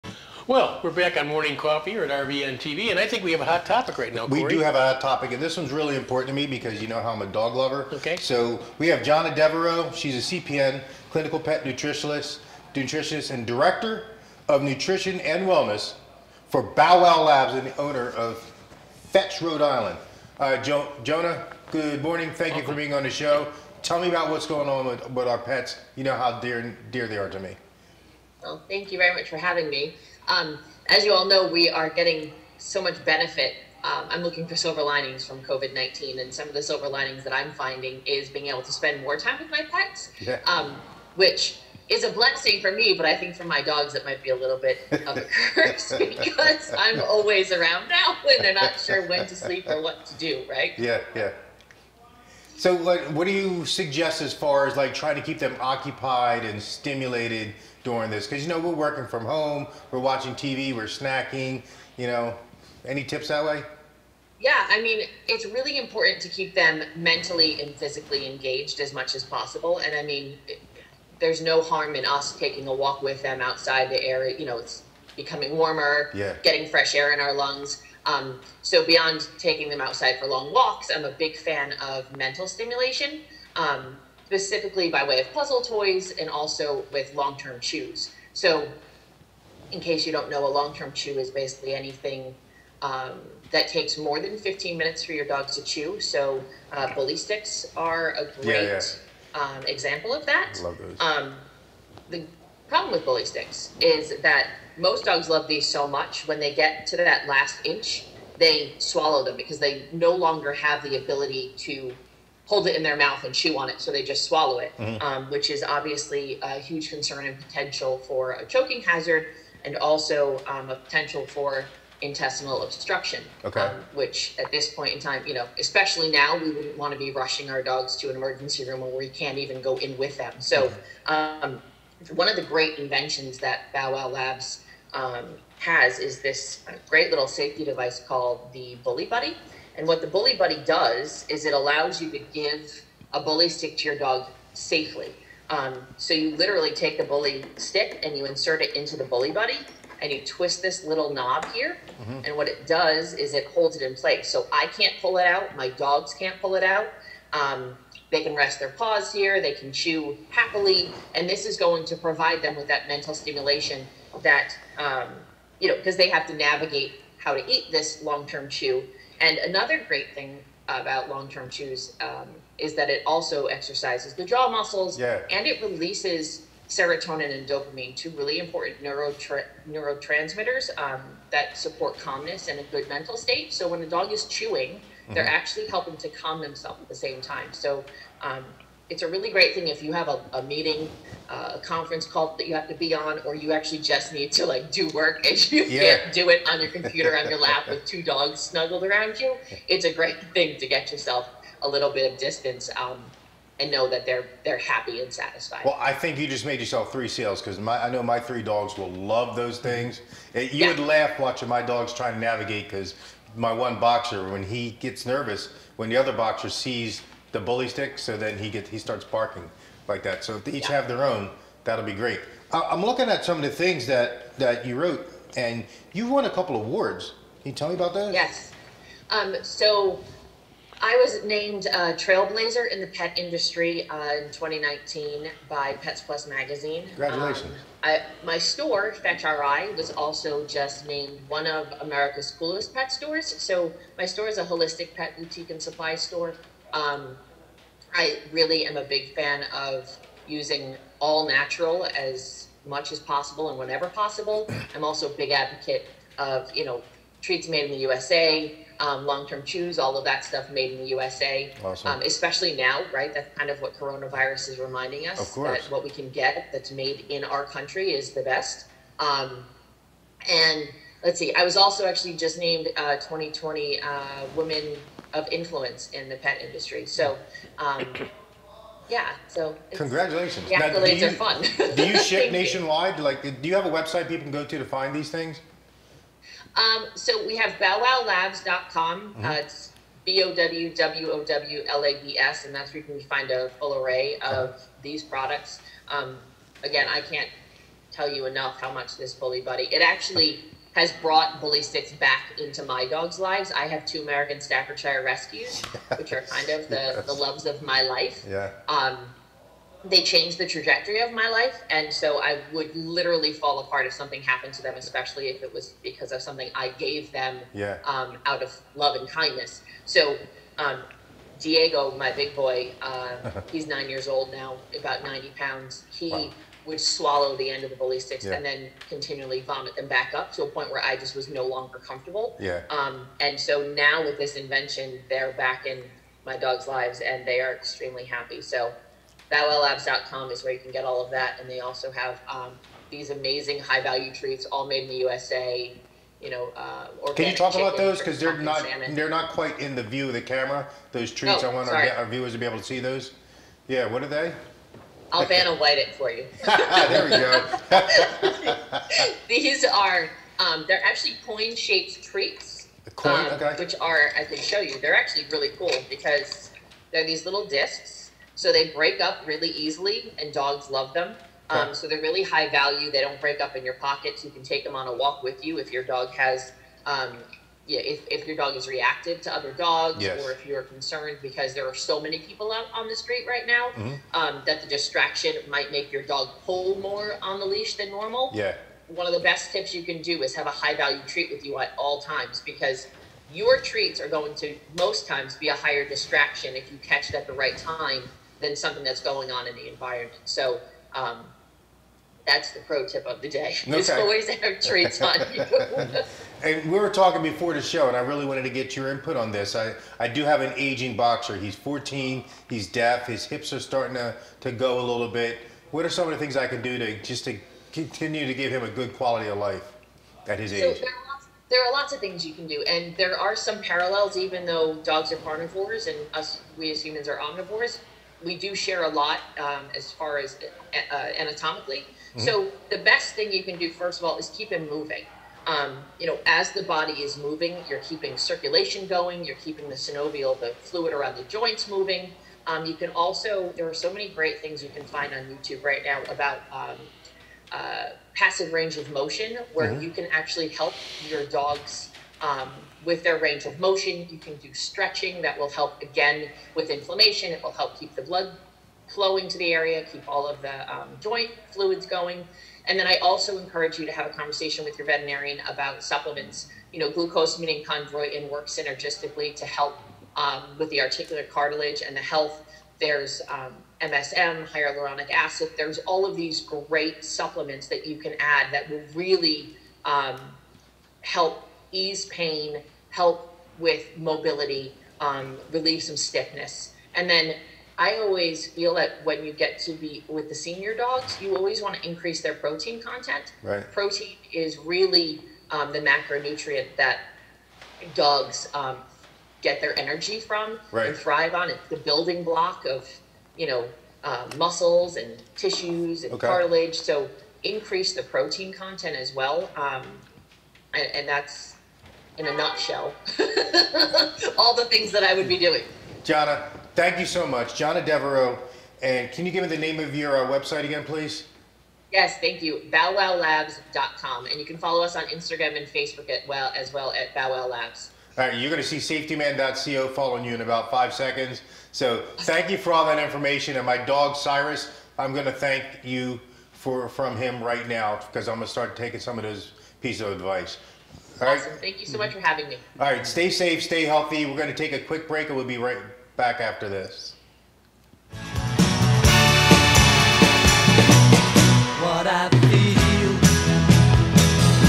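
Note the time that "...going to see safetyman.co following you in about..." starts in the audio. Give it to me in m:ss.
8:48.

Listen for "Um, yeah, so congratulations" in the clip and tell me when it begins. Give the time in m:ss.
4:37.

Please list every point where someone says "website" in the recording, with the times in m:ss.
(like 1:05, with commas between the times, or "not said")
4:43, 8:40.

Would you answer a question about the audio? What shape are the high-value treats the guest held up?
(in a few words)
coin shaped.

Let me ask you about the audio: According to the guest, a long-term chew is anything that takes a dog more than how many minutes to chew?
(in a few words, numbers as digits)
15.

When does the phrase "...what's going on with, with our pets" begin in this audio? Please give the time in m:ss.
0:24.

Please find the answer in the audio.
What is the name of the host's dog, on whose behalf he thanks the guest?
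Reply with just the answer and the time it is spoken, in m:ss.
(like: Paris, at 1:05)
Cyrus, at 8:54.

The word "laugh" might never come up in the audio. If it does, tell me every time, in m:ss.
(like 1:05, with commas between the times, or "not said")
3:30.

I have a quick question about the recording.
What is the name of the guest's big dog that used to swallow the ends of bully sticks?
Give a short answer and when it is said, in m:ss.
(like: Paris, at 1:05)
Diego, at 5:21.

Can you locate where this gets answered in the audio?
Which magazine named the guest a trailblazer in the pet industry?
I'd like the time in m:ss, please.
3:55.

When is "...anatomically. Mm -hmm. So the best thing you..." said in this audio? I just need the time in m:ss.
7:11.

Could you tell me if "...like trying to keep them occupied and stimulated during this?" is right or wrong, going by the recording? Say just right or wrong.
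right.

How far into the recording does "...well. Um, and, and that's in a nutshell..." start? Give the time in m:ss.
8:29.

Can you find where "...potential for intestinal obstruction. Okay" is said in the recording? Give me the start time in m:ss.
2:00.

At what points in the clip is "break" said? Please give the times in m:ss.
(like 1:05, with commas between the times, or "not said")
6:08, 6:13, 9:05.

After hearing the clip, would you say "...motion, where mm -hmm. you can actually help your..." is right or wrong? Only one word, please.
right.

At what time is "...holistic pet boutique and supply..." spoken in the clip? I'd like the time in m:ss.
4:04.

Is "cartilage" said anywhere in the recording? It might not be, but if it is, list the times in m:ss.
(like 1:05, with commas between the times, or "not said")
7:51, 8:26.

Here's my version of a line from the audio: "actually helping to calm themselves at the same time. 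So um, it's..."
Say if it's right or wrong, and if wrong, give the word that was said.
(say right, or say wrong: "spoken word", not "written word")
right.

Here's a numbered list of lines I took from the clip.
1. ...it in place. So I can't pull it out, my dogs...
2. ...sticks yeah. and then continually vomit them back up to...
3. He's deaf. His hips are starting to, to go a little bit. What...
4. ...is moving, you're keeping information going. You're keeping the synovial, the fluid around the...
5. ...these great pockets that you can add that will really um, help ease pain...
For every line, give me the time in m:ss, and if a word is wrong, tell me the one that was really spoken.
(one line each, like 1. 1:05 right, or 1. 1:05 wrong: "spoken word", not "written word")
1. 2:33 right
2. 5:27 right
3. 6:52 right
4. 7:17 wrong: "circulation", not "information"
5. 7:56 wrong: "supplements", not "pockets".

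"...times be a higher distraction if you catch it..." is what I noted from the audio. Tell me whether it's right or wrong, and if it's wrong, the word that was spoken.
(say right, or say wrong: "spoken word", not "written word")
right.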